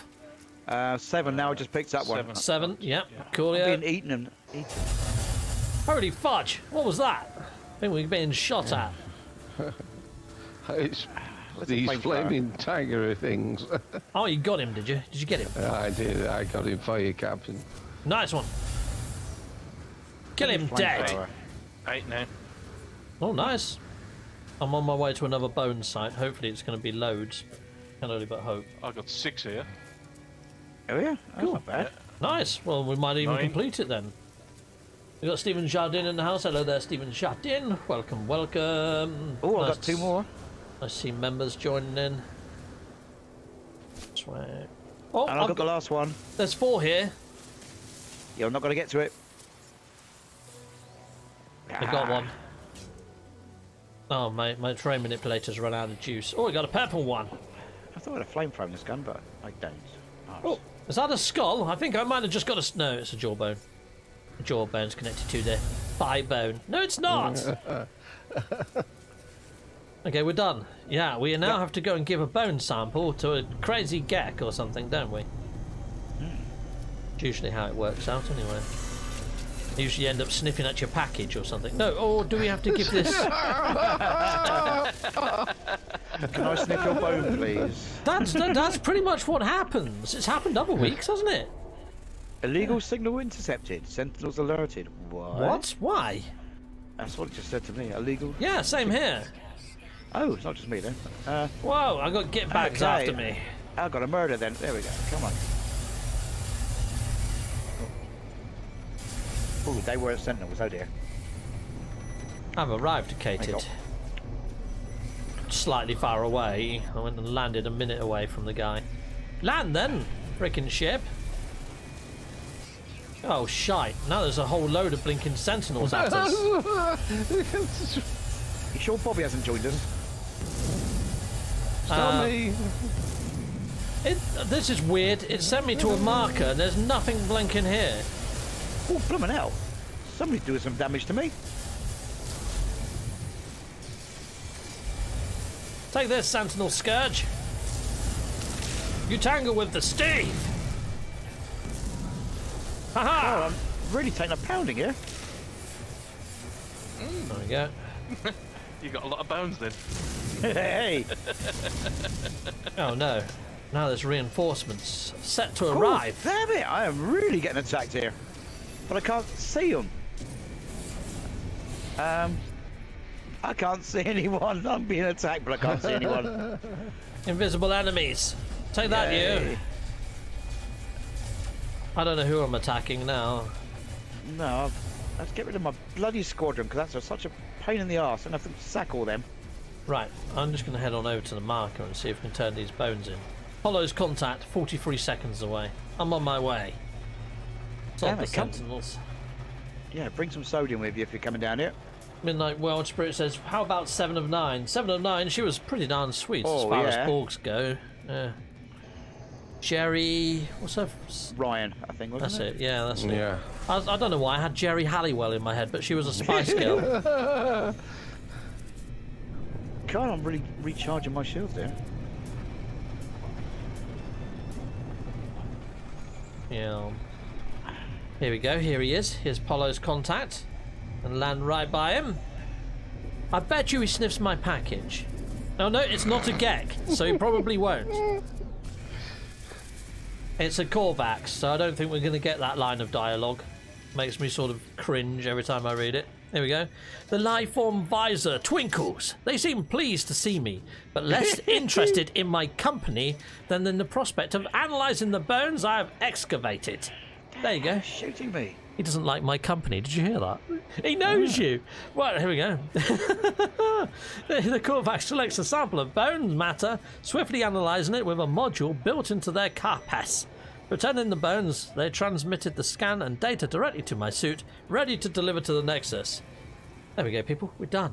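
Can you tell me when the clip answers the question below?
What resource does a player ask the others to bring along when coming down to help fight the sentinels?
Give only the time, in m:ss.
3:20.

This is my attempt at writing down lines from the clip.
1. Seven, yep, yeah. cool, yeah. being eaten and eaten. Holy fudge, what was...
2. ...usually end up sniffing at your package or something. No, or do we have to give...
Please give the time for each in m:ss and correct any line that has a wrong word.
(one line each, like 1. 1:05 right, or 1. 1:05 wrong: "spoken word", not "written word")
1. 0:02 right
2. 1:19 right.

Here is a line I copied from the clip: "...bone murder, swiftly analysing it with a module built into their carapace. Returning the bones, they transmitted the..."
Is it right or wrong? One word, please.
wrong.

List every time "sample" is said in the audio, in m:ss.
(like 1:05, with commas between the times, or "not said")
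1:12, 4:25.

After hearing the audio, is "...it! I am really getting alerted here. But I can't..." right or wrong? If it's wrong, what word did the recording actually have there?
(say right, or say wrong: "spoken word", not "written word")
wrong: "attacked", not "alerted".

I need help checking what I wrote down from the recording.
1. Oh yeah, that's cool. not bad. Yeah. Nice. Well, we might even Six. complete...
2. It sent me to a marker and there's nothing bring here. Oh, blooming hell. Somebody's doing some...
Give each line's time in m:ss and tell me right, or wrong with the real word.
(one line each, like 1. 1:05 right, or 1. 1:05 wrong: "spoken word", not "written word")
1. 0:30 wrong: "Nine", not "Six"
2. 2:15 wrong: "blinking", not "bring".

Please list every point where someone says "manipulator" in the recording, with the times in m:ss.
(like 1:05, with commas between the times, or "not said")
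0:55.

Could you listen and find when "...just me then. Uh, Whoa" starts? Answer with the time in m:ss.
1:40.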